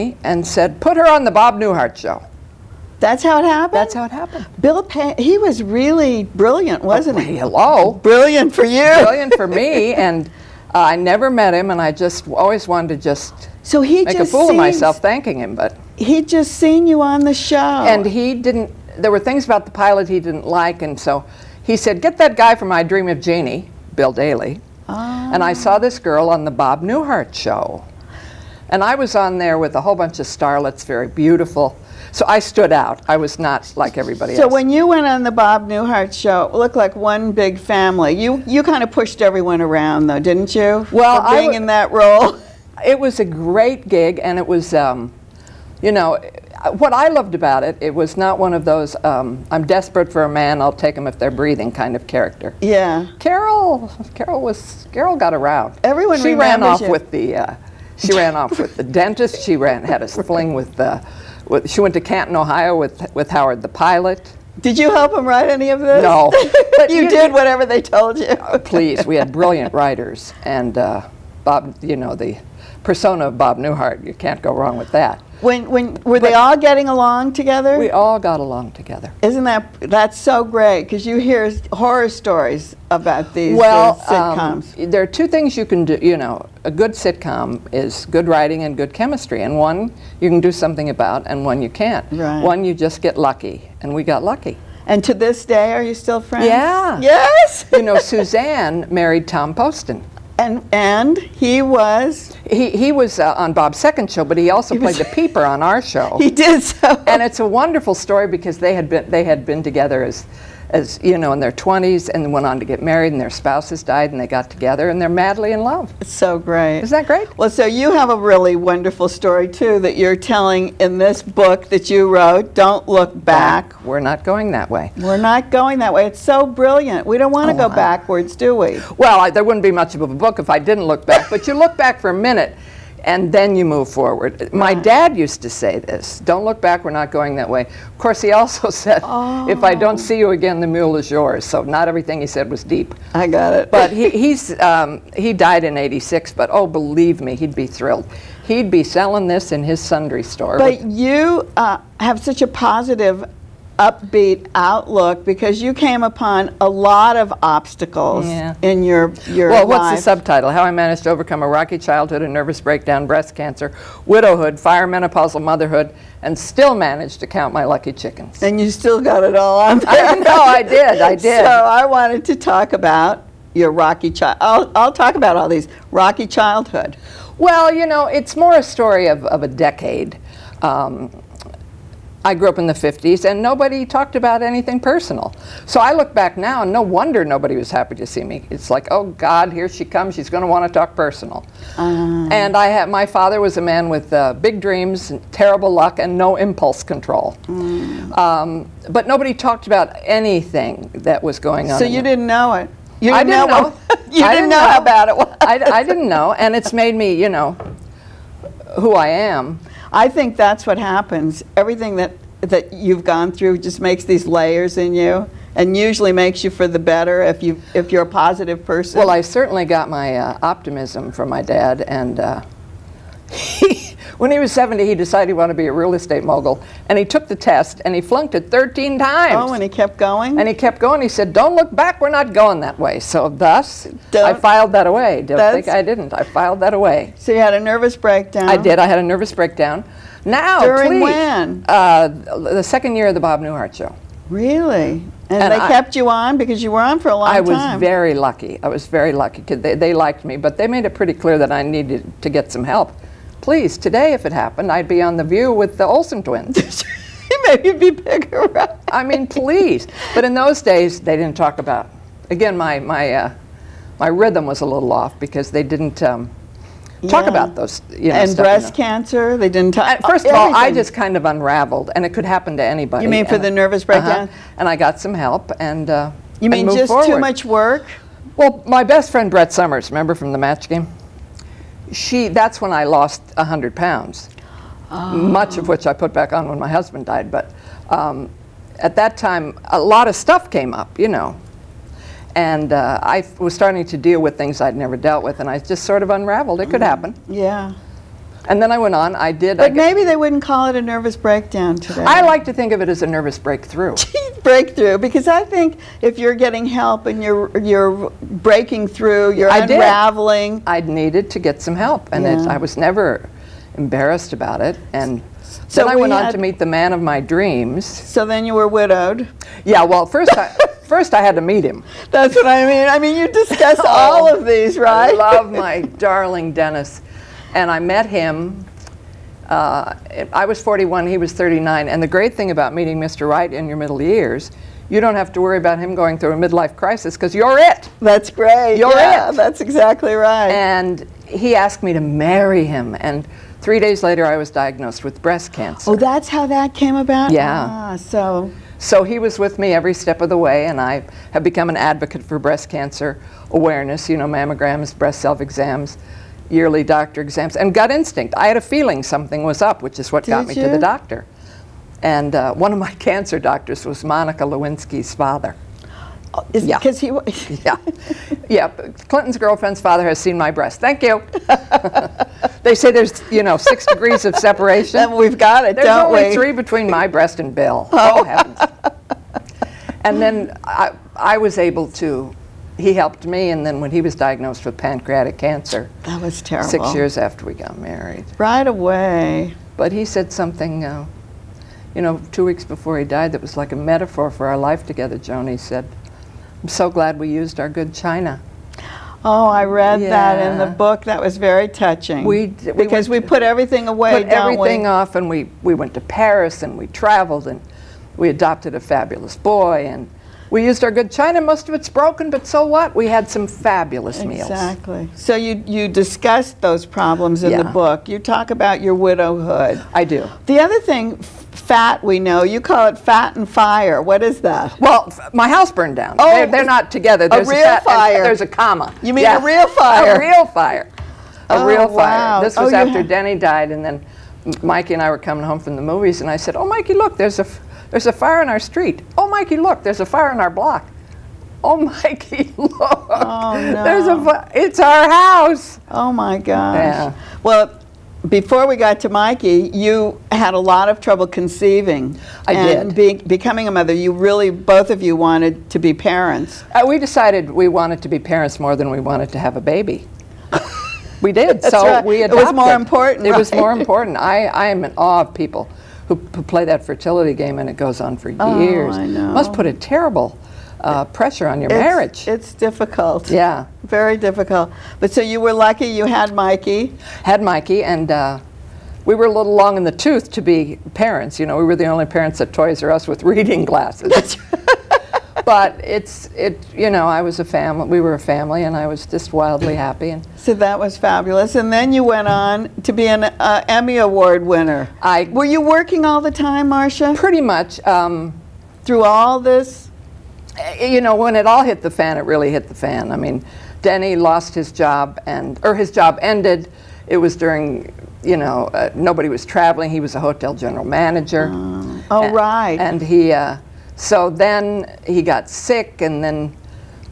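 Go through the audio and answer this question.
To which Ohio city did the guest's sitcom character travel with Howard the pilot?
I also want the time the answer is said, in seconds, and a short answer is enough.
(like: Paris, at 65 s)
Canton, at 62 s.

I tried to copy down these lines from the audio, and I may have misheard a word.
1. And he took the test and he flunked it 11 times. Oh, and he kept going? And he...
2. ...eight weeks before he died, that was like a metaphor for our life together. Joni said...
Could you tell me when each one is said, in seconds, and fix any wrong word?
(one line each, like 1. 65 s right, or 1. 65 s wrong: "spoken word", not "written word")
1. 226 s wrong: "13", not "11"
2. 392 s wrong: "two", not "eight".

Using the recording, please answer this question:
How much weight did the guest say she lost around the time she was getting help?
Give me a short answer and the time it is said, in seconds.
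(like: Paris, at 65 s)
100 pounds, at 283 s.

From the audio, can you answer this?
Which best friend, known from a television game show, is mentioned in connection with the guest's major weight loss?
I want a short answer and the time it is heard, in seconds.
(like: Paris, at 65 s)
Brett Somers, at 279 s.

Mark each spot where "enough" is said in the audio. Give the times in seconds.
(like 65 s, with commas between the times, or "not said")
not said.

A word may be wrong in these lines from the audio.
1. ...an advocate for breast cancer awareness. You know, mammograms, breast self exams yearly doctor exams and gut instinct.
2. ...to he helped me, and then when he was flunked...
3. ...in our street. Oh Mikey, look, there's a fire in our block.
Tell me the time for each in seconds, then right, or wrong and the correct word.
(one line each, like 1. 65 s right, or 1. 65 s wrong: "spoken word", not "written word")
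1. 351 s right
2. 381 s wrong: "diagnosed", not "flunked"
3. 438 s right.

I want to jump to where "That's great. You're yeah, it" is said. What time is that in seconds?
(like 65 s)
337 s.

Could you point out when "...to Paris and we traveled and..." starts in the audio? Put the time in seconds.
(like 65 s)
405 s.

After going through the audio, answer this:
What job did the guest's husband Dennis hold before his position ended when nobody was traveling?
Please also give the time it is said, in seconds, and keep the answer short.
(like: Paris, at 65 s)
Hotel general manager, at 510 s.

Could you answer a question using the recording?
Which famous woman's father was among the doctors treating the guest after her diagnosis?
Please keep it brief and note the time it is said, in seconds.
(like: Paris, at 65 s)
Monica Lewinsky, at 364 s.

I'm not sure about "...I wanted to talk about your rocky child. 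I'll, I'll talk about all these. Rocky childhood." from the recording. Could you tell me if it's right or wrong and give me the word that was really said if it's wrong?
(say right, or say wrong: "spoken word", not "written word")
right.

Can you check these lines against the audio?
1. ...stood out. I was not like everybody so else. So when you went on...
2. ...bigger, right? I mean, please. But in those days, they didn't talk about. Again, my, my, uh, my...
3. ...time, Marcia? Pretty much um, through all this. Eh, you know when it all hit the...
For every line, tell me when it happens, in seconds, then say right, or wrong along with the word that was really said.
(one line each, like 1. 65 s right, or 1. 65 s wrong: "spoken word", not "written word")
1. 32 s right
2. 257 s right
3. 496 s right.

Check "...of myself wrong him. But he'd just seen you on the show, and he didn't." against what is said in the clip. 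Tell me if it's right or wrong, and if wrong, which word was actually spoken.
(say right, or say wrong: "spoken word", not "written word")
wrong: "thanking", not "wrong".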